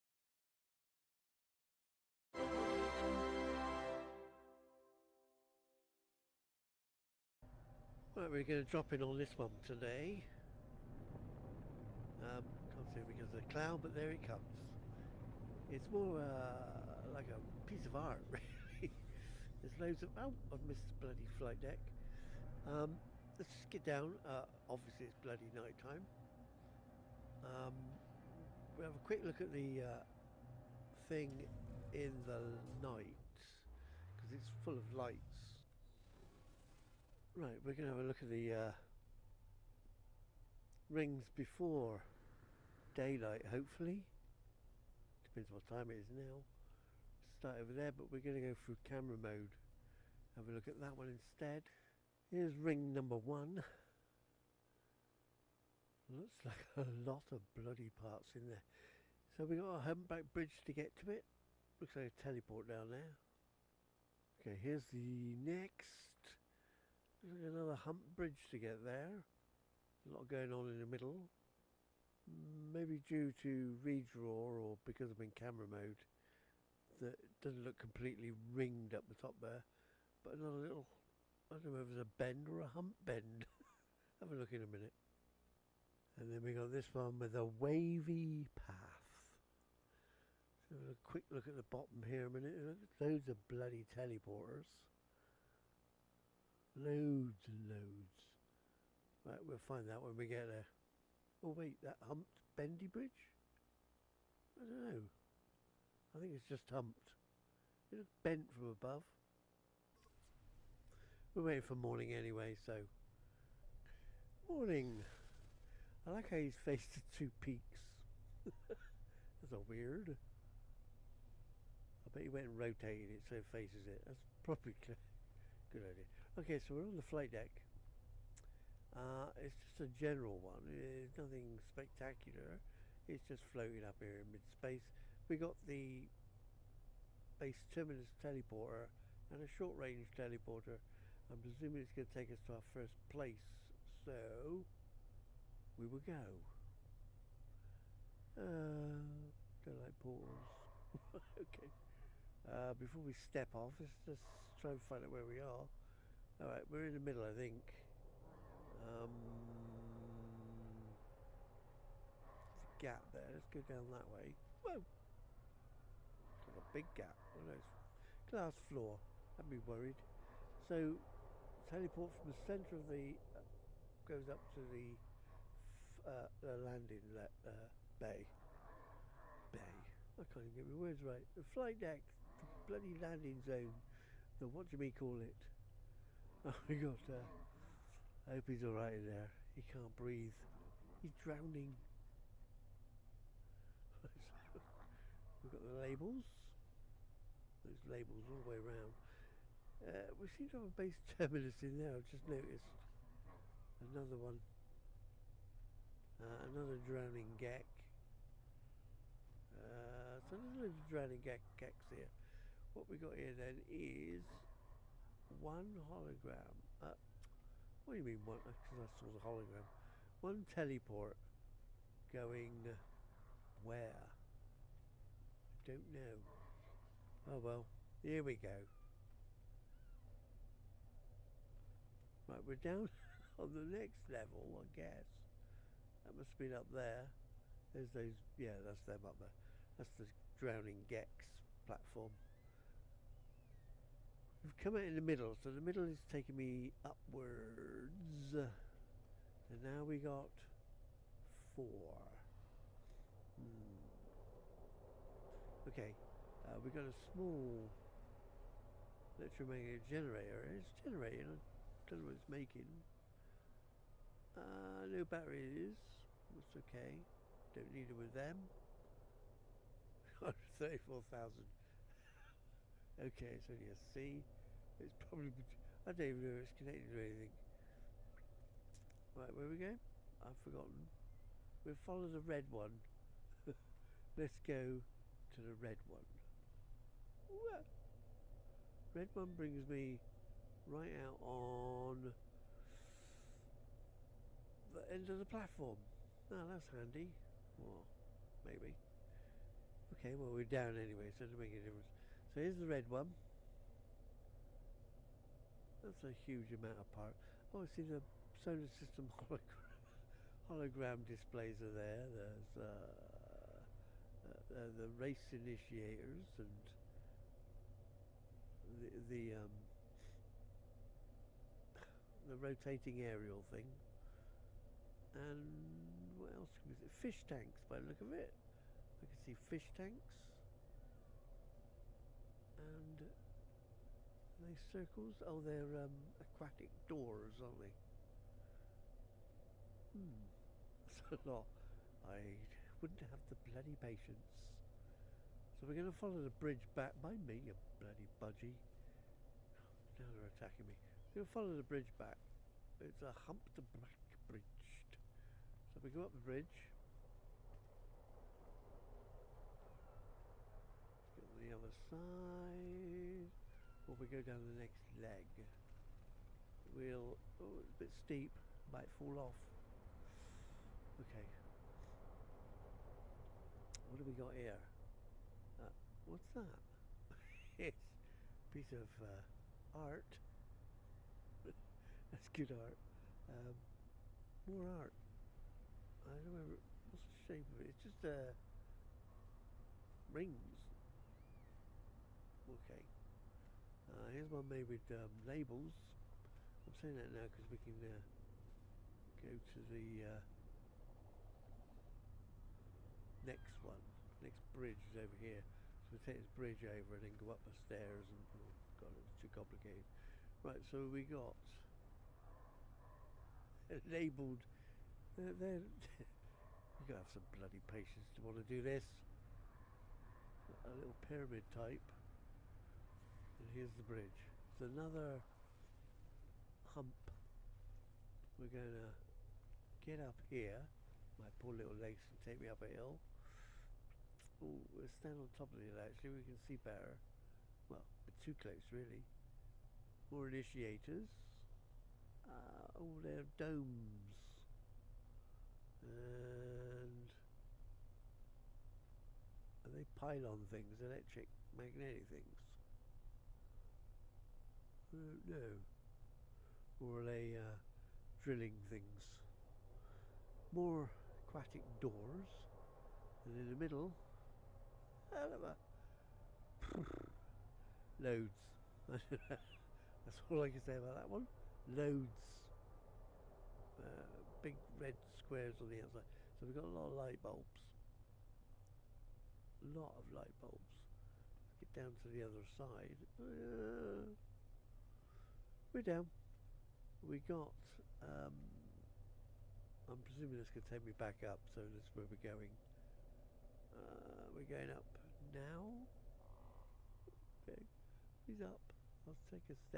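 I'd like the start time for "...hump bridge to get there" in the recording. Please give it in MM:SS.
01:07.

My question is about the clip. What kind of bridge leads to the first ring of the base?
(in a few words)
Humpback bridge.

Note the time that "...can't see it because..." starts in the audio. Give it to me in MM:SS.
00:12.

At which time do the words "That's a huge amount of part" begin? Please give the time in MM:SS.
05:05.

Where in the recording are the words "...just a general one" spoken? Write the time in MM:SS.
02:09.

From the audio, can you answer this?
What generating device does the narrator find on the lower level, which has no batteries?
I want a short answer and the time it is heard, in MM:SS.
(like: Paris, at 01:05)
Small electromagnetic generator, at 04:16.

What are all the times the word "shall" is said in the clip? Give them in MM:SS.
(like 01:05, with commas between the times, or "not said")
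not said.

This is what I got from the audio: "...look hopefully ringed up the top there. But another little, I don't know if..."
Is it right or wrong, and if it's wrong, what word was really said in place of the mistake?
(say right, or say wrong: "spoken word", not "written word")
wrong: "completely", not "hopefully".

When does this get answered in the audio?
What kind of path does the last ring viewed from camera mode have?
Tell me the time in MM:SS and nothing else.
01:27.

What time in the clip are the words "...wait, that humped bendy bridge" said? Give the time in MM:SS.
01:41.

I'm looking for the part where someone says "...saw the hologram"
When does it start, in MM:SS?
03:38.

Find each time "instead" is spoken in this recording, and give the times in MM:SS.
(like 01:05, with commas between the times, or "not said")
00:51.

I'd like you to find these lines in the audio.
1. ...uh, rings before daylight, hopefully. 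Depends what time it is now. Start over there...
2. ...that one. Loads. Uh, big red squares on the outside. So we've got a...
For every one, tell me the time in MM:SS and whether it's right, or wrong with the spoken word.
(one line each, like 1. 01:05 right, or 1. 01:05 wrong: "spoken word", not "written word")
1. 00:38 right
2. 07:50 right.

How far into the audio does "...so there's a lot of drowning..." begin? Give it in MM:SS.
03:30.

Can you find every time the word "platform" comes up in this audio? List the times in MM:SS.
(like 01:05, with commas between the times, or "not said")
04:01, 04:55.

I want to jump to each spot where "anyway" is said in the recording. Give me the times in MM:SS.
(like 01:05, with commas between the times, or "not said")
01:52, 05:00.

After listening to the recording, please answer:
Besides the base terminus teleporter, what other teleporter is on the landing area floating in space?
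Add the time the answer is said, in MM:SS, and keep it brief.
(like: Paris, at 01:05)
Short-range teleporter, at 02:19.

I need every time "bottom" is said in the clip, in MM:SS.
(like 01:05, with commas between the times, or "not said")
01:31.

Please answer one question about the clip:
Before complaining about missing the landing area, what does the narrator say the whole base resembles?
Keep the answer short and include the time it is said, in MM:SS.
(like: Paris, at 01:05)
A piece of art, at 00:17.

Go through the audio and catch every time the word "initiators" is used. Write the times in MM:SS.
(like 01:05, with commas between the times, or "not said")
05:15, 07:20.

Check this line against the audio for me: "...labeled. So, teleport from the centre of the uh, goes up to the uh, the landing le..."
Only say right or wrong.
wrong.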